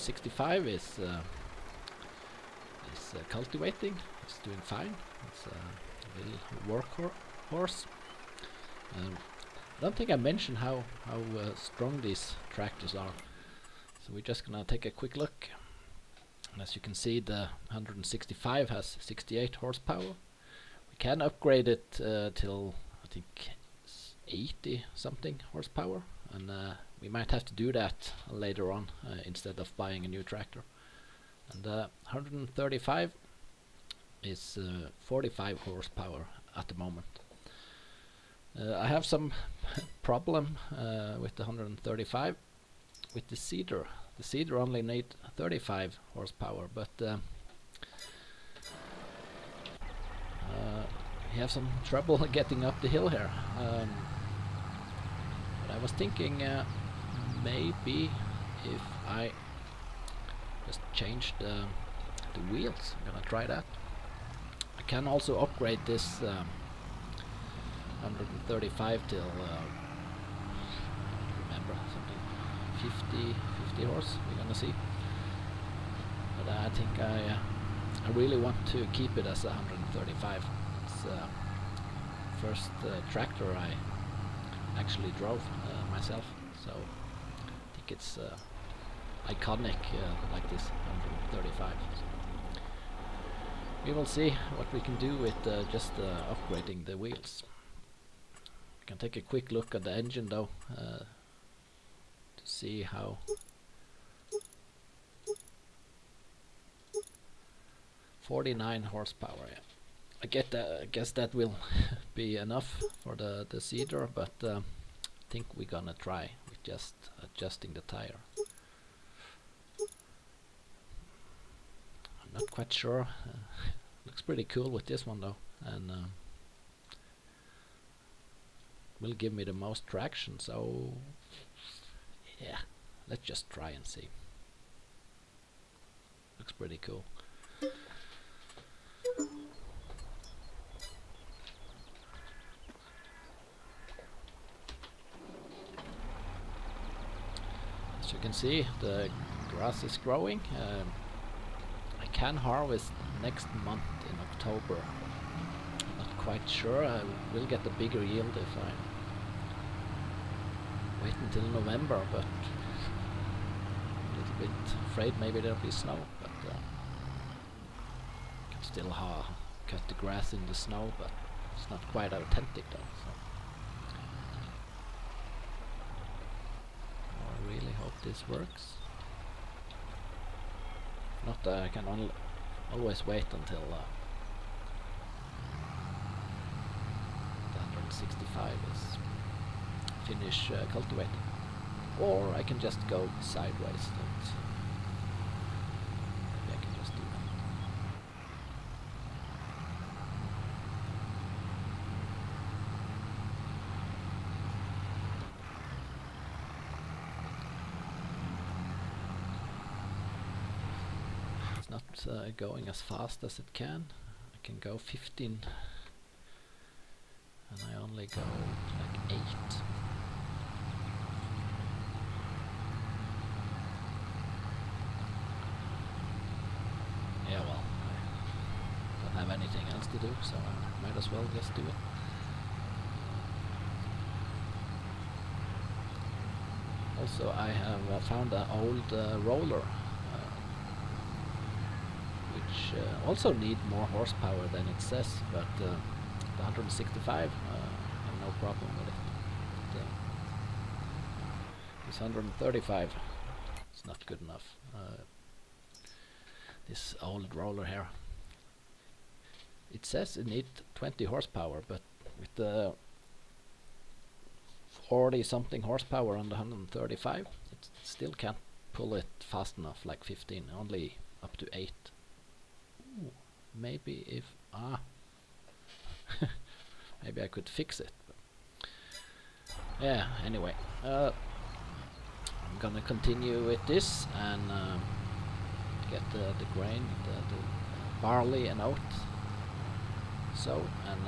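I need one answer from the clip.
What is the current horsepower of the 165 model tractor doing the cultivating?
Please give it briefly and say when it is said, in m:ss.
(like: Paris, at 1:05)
68, at 0:19.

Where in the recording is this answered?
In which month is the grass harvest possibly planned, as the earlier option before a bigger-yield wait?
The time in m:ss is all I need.
2:34.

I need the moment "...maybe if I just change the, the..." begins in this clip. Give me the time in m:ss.
0:57.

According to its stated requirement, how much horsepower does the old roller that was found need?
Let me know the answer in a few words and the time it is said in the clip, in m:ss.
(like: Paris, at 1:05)
20, at 4:20.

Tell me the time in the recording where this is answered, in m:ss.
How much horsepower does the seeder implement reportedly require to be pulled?
0:45.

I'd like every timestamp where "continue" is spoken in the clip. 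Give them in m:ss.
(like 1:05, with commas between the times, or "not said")
4:42.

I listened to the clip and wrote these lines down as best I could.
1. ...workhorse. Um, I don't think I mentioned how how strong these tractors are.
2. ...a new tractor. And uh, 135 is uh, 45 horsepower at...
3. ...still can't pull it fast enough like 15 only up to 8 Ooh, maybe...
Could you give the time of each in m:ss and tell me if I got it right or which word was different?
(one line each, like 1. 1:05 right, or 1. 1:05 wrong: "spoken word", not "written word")
1. 0:07 right
2. 0:30 right
3. 4:27 right.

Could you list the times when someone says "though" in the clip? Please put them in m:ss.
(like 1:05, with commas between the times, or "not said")
1:40, 2:05, 2:52.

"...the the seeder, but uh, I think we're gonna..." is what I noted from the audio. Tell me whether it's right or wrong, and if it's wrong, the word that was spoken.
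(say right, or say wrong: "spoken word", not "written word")
right.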